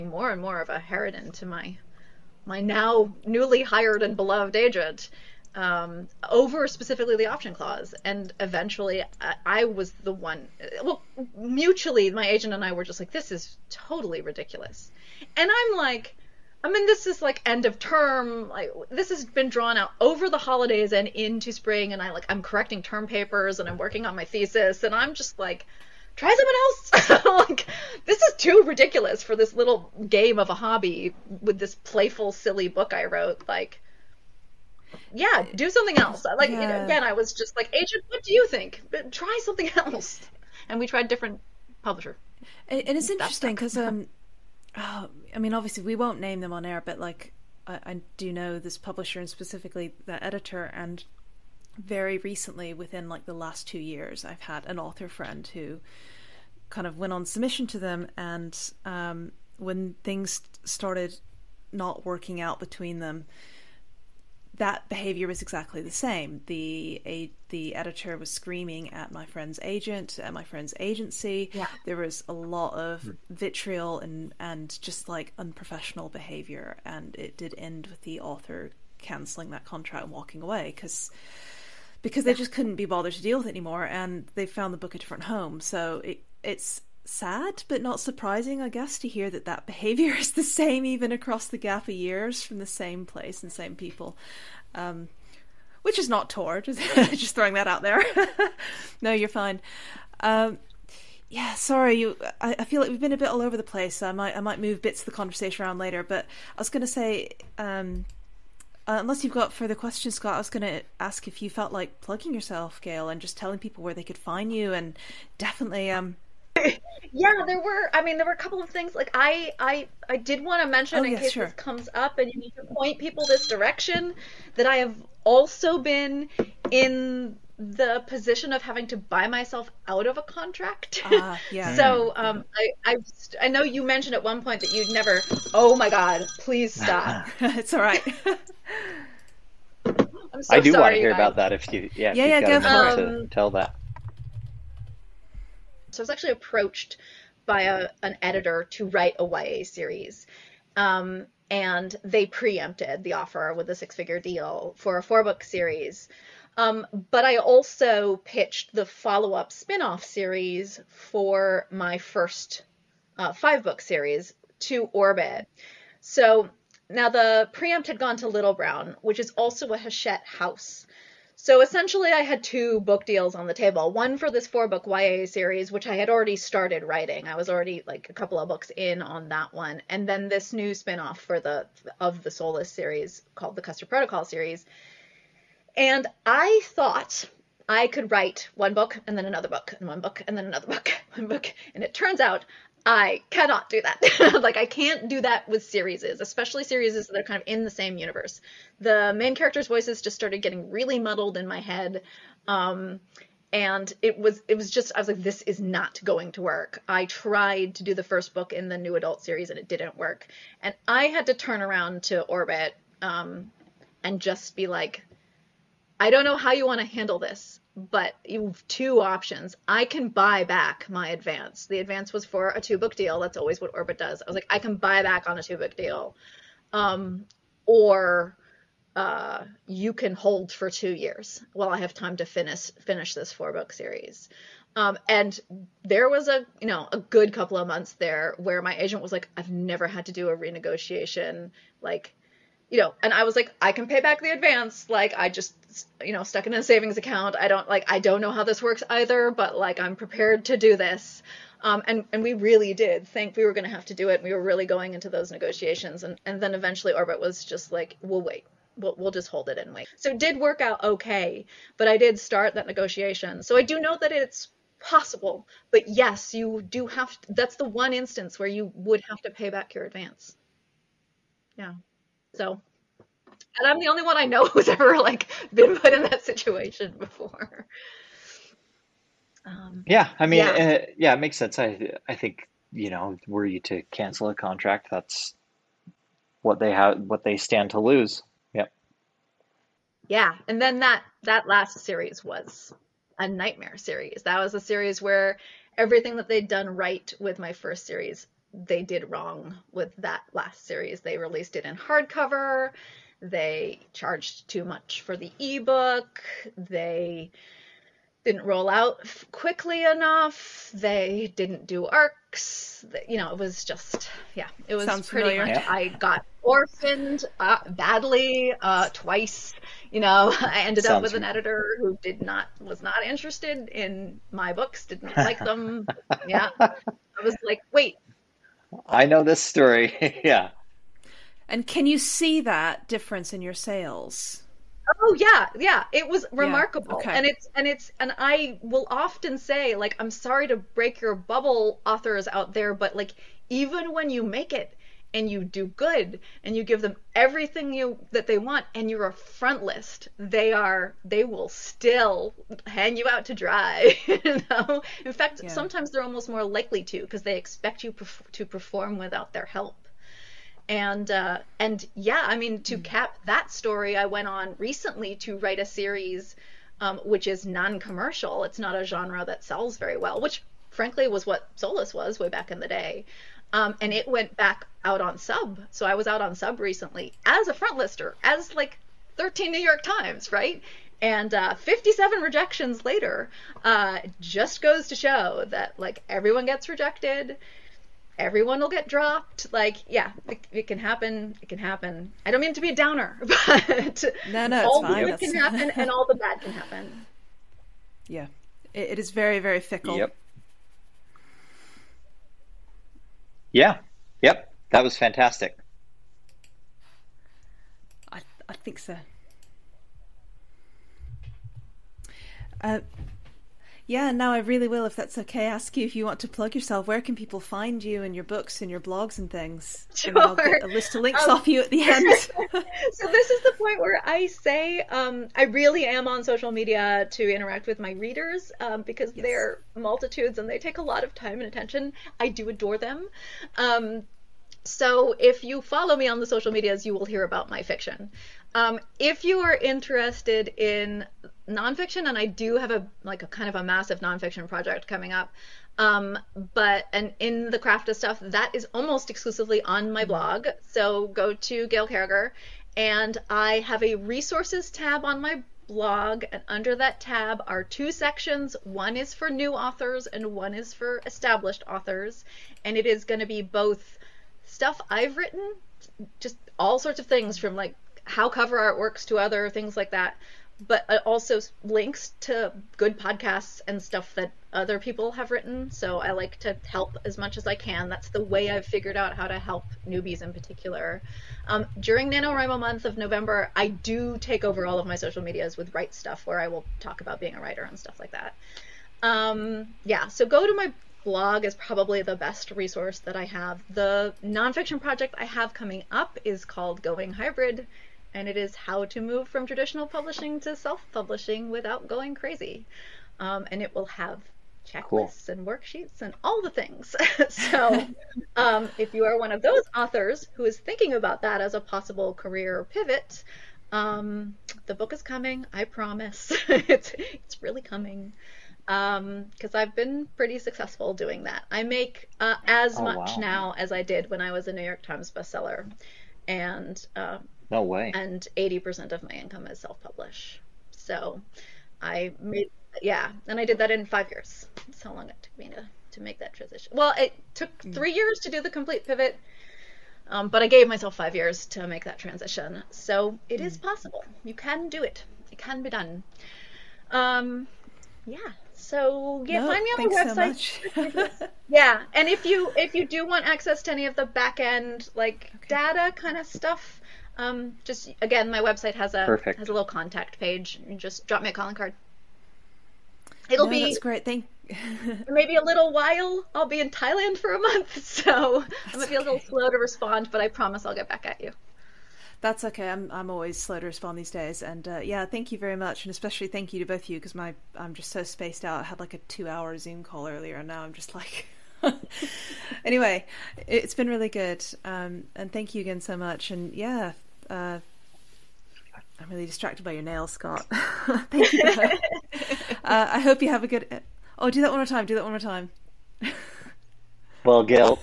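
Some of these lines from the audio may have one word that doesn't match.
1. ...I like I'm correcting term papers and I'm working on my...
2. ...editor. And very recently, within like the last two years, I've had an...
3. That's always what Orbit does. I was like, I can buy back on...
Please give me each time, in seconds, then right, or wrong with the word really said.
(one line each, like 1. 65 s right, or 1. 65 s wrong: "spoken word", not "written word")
1. 22 s right
2. 50 s right
3. 223 s right.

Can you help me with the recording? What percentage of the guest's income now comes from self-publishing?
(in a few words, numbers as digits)
80%.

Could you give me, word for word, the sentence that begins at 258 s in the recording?
We'll, we'll just hold it and wait.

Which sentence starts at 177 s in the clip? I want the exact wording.
I was already like a couple of books in on that one.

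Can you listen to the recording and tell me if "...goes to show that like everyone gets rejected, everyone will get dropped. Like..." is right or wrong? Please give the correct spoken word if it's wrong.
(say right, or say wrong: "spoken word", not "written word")
right.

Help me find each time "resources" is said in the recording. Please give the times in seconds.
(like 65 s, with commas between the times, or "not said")
453 s, 492 s.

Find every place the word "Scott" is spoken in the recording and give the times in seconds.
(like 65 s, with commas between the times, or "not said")
110 s, 590 s.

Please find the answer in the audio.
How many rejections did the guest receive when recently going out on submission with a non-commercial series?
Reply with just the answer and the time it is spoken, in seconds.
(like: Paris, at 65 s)
57, at 381 s.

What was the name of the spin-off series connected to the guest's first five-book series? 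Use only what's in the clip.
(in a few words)
The Custard Protocol.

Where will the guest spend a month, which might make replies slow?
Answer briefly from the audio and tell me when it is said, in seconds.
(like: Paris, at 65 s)
Thailand, at 566 s.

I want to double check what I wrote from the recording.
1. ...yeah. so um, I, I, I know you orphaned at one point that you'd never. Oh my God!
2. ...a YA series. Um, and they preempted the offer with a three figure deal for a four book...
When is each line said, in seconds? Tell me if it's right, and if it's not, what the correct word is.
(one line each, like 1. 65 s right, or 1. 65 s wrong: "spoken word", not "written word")
1. 131 s wrong: "mentioned", not "orphaned"
2. 149 s wrong: "six", not "three".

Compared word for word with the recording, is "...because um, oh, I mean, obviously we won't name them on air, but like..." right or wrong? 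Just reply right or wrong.
right.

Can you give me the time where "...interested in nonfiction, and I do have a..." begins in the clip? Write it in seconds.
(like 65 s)
439 s.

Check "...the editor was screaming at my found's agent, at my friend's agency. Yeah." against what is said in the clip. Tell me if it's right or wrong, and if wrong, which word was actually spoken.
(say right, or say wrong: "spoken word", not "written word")
wrong: "friend", not "found".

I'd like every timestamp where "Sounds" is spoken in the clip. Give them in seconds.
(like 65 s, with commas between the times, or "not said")
314 s, 320 s.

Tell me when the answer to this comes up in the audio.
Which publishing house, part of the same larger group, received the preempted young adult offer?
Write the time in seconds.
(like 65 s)
168 s.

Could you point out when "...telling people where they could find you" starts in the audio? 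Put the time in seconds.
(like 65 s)
113 s.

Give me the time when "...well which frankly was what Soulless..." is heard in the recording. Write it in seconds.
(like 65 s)
369 s.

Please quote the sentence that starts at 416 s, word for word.
Where can people find you and your books and your blogs and things?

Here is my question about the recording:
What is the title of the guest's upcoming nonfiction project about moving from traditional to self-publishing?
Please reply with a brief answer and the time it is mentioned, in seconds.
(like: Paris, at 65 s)
Going Hybrid, at 496 s.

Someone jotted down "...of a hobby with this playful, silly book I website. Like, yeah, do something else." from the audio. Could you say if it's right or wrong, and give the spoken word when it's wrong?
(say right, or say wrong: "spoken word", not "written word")
wrong: "wrote", not "website".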